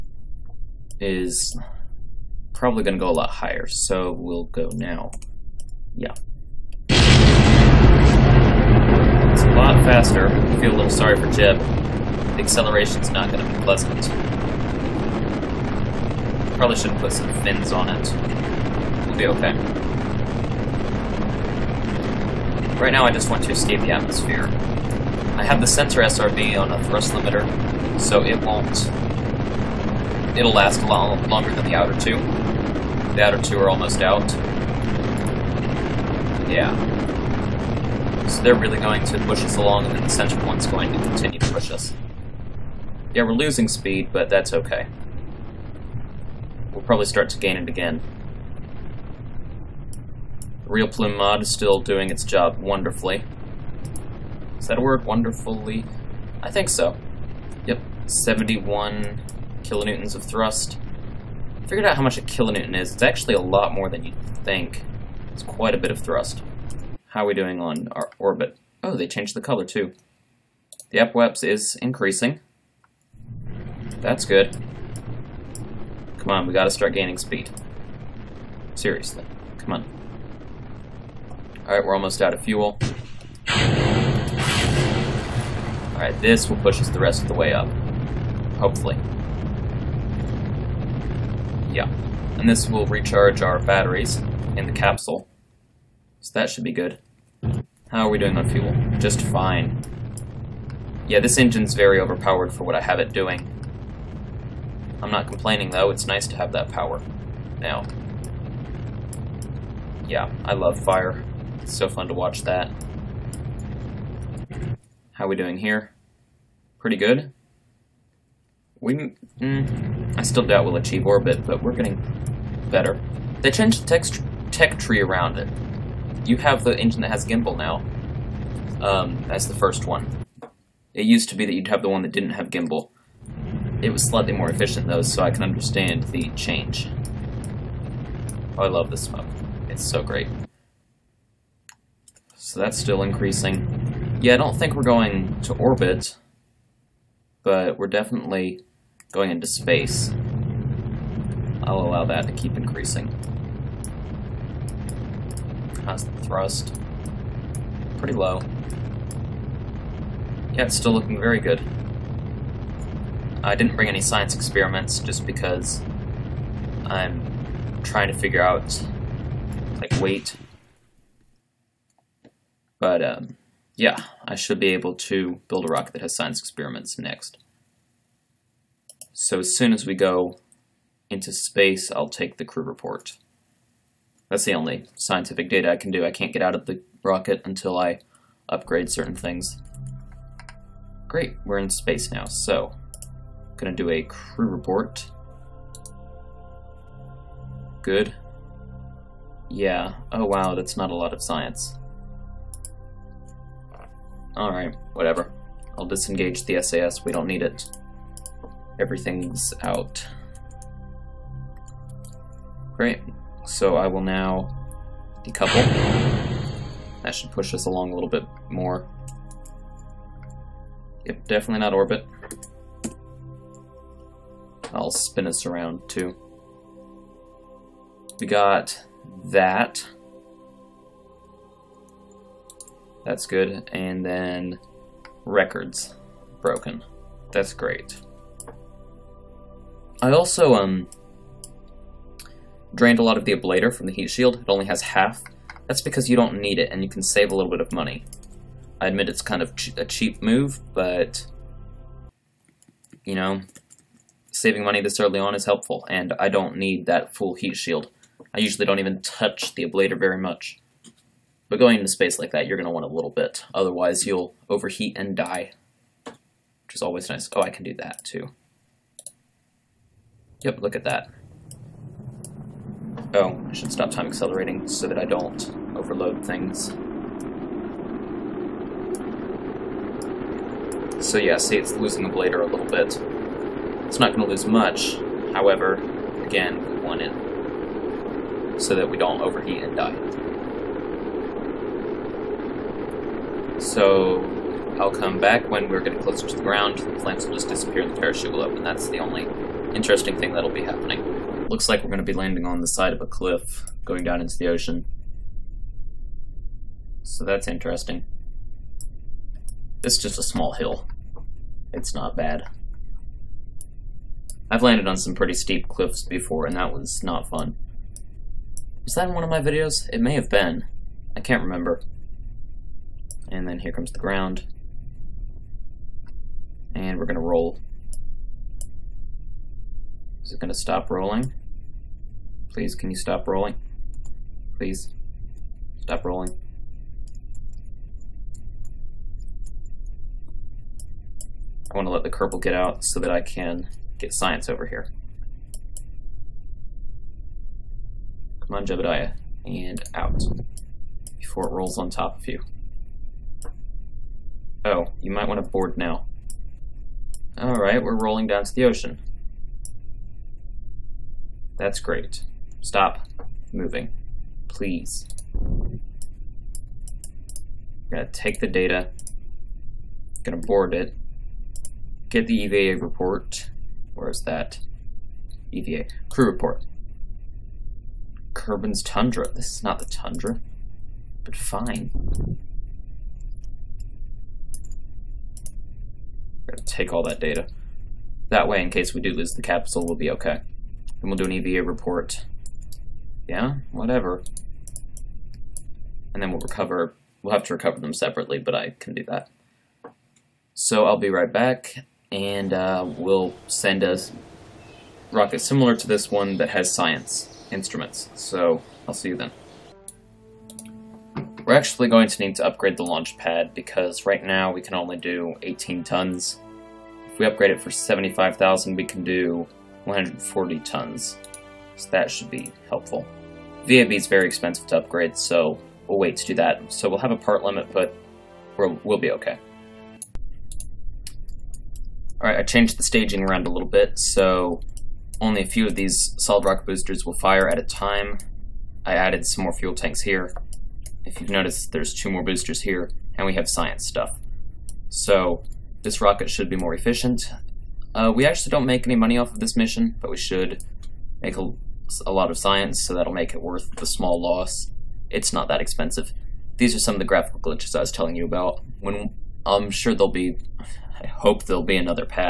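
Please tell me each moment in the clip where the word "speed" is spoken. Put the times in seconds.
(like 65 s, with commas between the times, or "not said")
43 s, 77 s.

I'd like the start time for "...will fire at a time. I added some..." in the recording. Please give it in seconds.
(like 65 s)
437 s.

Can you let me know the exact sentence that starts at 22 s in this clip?
Right now I just want to escape the atmosphere.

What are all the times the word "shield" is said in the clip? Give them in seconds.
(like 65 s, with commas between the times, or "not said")
244 s, 257 s.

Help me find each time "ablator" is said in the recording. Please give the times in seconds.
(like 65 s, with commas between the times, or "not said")
243 s, 259 s, 282 s.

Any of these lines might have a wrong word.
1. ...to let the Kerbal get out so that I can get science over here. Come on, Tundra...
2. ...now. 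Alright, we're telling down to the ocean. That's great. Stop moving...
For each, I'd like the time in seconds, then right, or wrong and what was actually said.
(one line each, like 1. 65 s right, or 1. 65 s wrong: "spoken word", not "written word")
1. 341 s wrong: "Jebediah", not "Tundra"
2. 355 s wrong: "rolling", not "telling".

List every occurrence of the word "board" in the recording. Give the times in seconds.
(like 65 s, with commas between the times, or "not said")
355 s, 370 s.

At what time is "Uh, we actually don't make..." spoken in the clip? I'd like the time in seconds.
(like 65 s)
447 s.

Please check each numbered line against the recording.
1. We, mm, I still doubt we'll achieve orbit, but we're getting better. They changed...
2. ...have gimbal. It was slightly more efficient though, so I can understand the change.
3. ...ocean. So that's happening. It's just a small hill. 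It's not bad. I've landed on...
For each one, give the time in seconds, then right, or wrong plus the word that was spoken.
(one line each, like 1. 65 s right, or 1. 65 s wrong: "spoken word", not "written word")
1. 118 s right
2. 132 s right
3. 304 s wrong: "interesting", not "happening".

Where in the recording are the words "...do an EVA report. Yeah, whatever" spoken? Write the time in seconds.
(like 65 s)
391 s.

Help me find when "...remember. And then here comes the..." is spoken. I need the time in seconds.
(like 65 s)
321 s.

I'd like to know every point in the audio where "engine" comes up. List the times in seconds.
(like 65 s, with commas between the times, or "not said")
101 s, 126 s.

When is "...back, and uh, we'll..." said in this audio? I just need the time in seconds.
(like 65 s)
401 s.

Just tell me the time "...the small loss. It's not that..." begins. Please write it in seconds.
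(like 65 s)
453 s.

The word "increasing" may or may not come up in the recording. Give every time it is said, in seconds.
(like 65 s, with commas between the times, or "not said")
71 s, 143 s, 152 s.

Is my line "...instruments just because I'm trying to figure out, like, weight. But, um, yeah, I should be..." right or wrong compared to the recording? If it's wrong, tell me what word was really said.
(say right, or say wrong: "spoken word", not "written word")
wrong: "experiments", not "instruments".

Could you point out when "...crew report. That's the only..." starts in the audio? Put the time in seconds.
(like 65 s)
182 s.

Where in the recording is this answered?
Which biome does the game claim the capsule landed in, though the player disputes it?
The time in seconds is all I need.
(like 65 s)
378 s.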